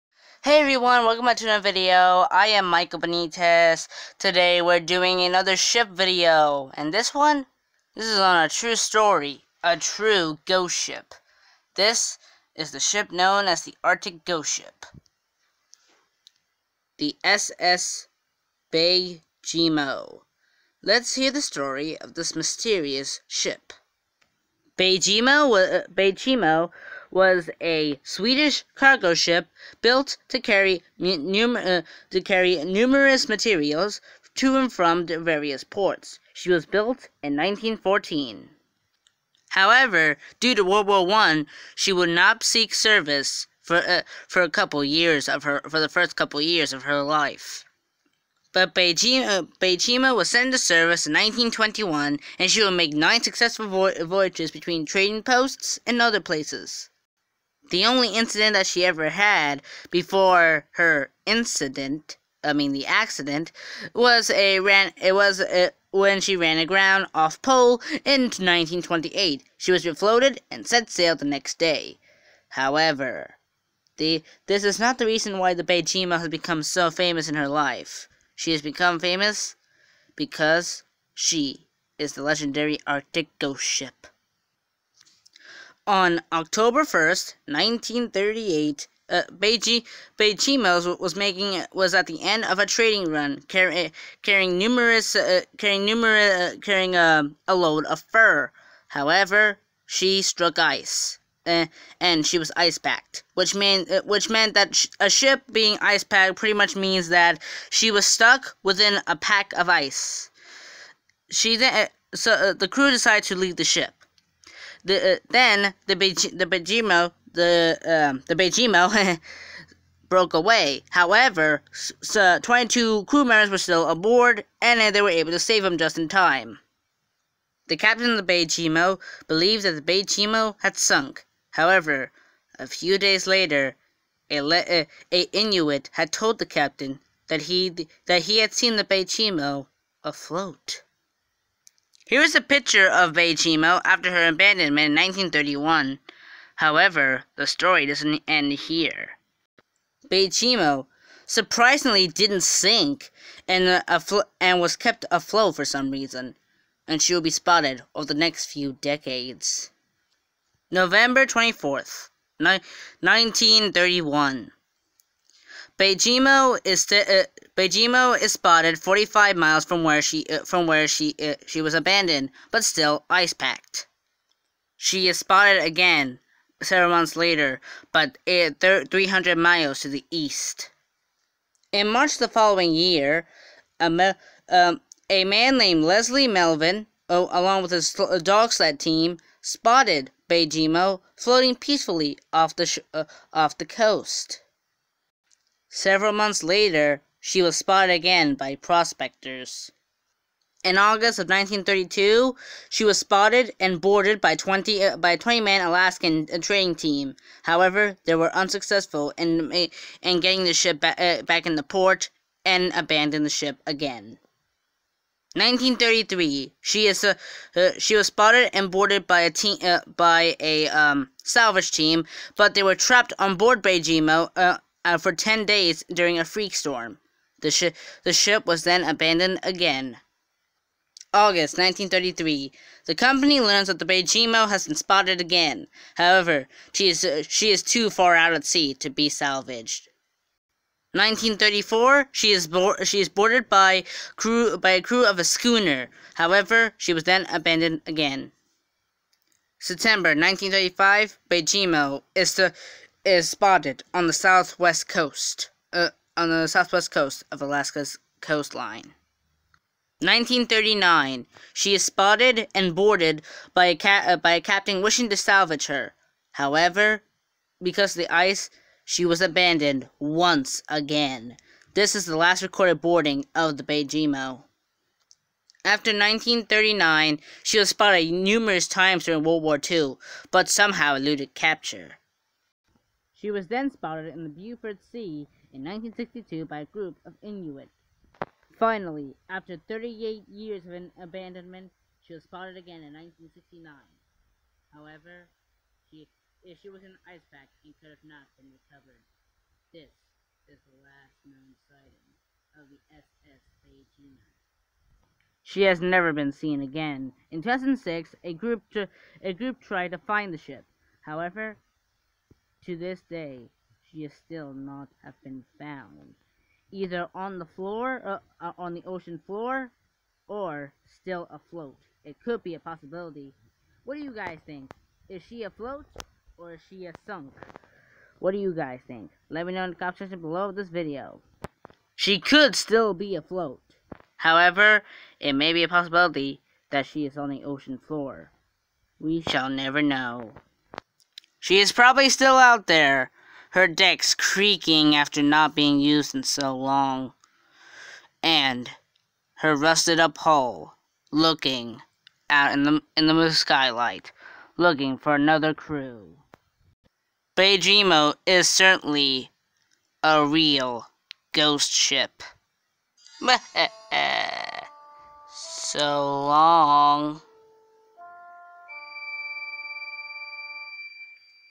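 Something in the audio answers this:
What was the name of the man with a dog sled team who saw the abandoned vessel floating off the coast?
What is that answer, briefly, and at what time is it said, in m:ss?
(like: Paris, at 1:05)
Leslie Melvin, at 3:05.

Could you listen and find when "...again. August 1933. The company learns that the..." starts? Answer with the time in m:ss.
3:49.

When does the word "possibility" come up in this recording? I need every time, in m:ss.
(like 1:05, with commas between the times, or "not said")
5:22, 5:35.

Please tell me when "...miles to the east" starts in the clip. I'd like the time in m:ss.
2:59.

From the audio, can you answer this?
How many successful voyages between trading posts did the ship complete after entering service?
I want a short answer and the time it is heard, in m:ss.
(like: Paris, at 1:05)
nine, at 0:52.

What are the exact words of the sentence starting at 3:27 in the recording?
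However, they were unsuccessful in in getting the ship ba uh, back in the port and abandoned the ship again.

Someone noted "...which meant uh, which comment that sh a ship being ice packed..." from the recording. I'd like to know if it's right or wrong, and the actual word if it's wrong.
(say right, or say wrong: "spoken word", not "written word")
wrong: "meant", not "comment".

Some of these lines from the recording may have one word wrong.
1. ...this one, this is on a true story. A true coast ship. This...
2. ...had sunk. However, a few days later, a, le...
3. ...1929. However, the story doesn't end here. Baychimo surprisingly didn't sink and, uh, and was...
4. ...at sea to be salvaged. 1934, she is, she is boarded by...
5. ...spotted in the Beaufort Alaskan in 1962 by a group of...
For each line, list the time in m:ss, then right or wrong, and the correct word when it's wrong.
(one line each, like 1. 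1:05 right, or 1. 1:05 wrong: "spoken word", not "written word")
1. 0:06 wrong: "ghost", not "coast"
2. 2:10 right
3. 2:24 wrong: "1931", not "1929"
4. 3:58 right
5. 4:43 wrong: "Sea", not "Alaskan".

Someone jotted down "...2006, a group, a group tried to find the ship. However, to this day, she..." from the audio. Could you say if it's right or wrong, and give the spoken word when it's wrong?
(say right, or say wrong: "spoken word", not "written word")
right.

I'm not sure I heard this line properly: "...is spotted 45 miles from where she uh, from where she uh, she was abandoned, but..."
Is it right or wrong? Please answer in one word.
right.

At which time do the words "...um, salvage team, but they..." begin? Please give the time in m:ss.
3:40.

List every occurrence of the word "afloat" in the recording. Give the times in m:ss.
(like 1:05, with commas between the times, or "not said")
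2:20, 2:35, 5:21, 5:25, 5:33.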